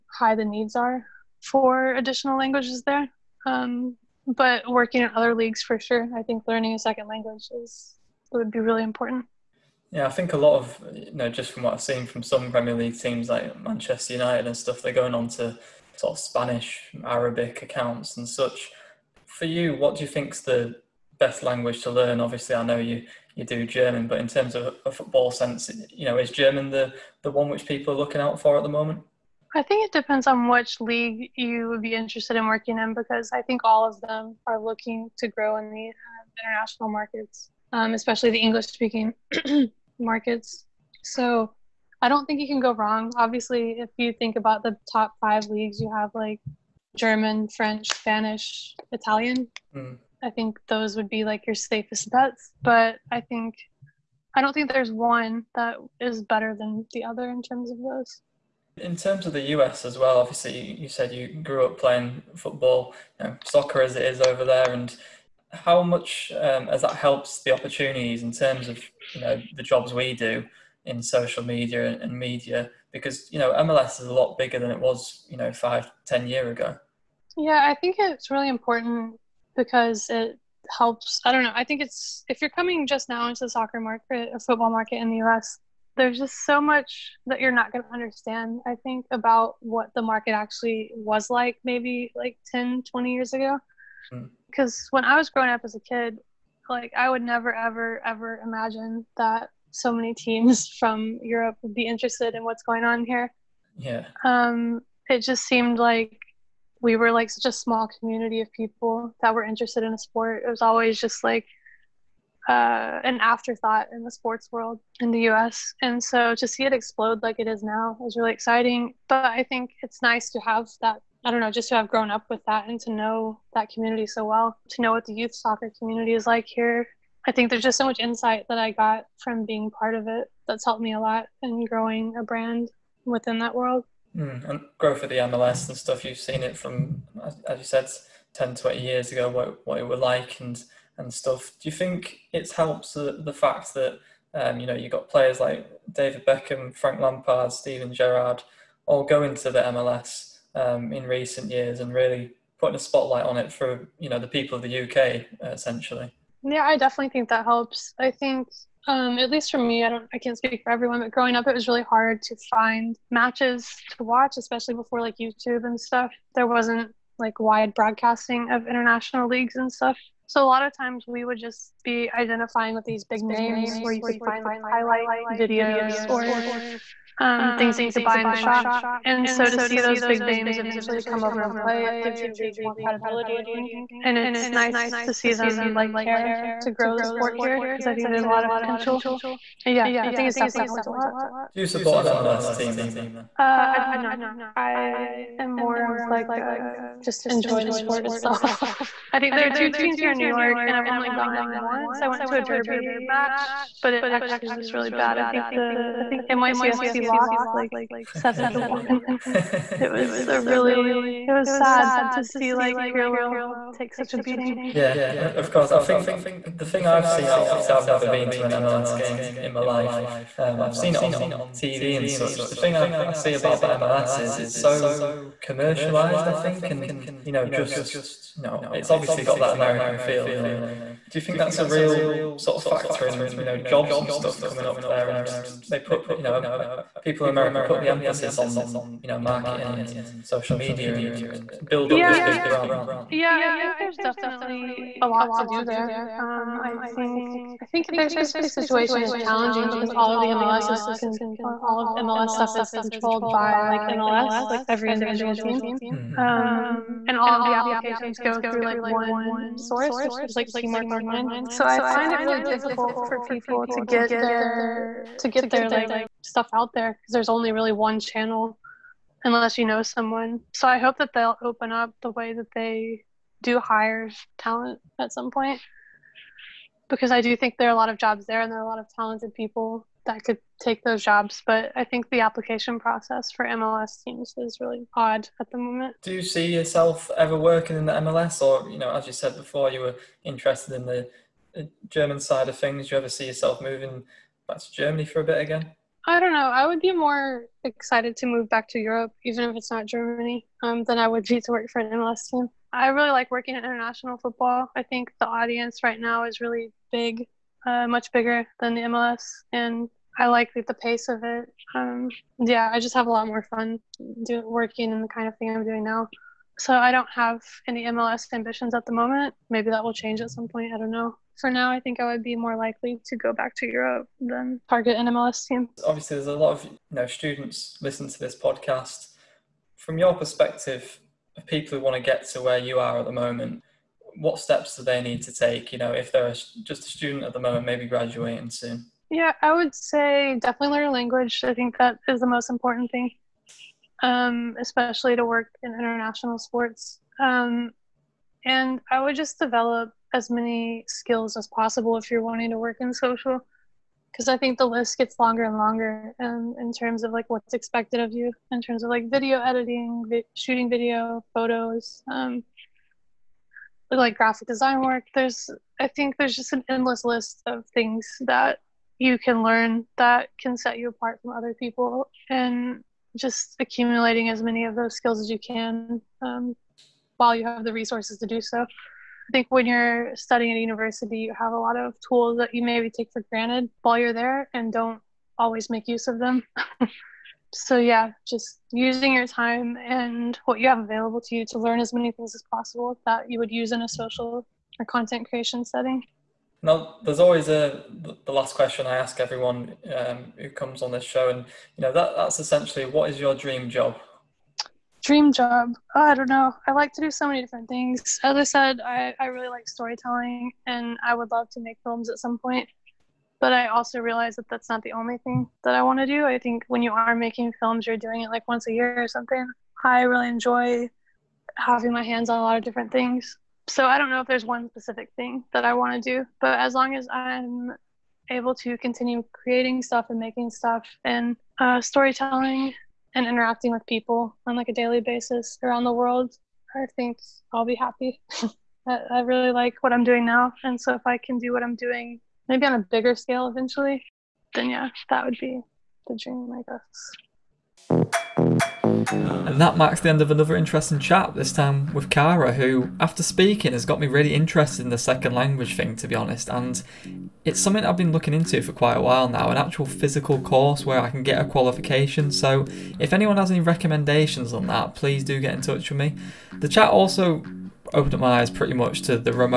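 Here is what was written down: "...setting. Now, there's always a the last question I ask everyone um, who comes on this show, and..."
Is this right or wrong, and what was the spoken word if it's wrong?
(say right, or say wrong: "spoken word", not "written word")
right.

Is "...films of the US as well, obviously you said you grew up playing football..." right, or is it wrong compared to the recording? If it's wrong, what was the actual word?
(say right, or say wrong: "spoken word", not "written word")
wrong: "terms", not "films".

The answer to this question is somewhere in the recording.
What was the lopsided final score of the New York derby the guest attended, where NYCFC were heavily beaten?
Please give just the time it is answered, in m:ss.
3:28.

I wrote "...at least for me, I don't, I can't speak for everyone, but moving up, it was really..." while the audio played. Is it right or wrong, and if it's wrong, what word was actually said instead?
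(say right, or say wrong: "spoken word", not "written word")
wrong: "growing", not "moving".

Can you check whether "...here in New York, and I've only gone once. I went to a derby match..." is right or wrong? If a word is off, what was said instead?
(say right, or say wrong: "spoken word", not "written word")
right.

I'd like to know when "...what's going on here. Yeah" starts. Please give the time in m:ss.
1:42.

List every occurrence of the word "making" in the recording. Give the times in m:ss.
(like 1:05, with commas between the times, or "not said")
6:57, 7:10.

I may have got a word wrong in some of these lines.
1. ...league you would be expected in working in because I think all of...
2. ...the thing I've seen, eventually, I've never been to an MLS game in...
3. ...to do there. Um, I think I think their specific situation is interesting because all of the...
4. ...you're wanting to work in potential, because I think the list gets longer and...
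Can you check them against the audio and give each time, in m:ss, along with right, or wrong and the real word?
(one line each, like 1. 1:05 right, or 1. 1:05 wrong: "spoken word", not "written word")
1. 0:30 wrong: "interested", not "expected"
2. 3:36 wrong: "obviously", not "eventually"
3. 4:05 wrong: "challenging", not "interesting"
4. 5:52 wrong: "social", not "potential".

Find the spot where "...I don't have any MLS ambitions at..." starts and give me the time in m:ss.
5:16.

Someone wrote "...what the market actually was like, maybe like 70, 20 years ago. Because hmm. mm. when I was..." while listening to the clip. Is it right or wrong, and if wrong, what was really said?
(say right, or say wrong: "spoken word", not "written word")
wrong: "10", not "70".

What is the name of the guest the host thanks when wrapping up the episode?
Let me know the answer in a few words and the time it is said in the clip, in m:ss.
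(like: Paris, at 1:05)
Kara, at 7:32.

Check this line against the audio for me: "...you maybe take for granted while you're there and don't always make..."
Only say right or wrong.
right.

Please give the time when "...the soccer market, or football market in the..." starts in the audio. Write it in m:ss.
1:23.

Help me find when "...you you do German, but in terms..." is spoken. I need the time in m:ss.
0:22.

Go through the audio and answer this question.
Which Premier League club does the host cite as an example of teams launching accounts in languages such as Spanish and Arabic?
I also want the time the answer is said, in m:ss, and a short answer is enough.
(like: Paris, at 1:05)
Manchester United, at 0:13.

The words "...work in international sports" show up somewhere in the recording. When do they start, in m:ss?
5:45.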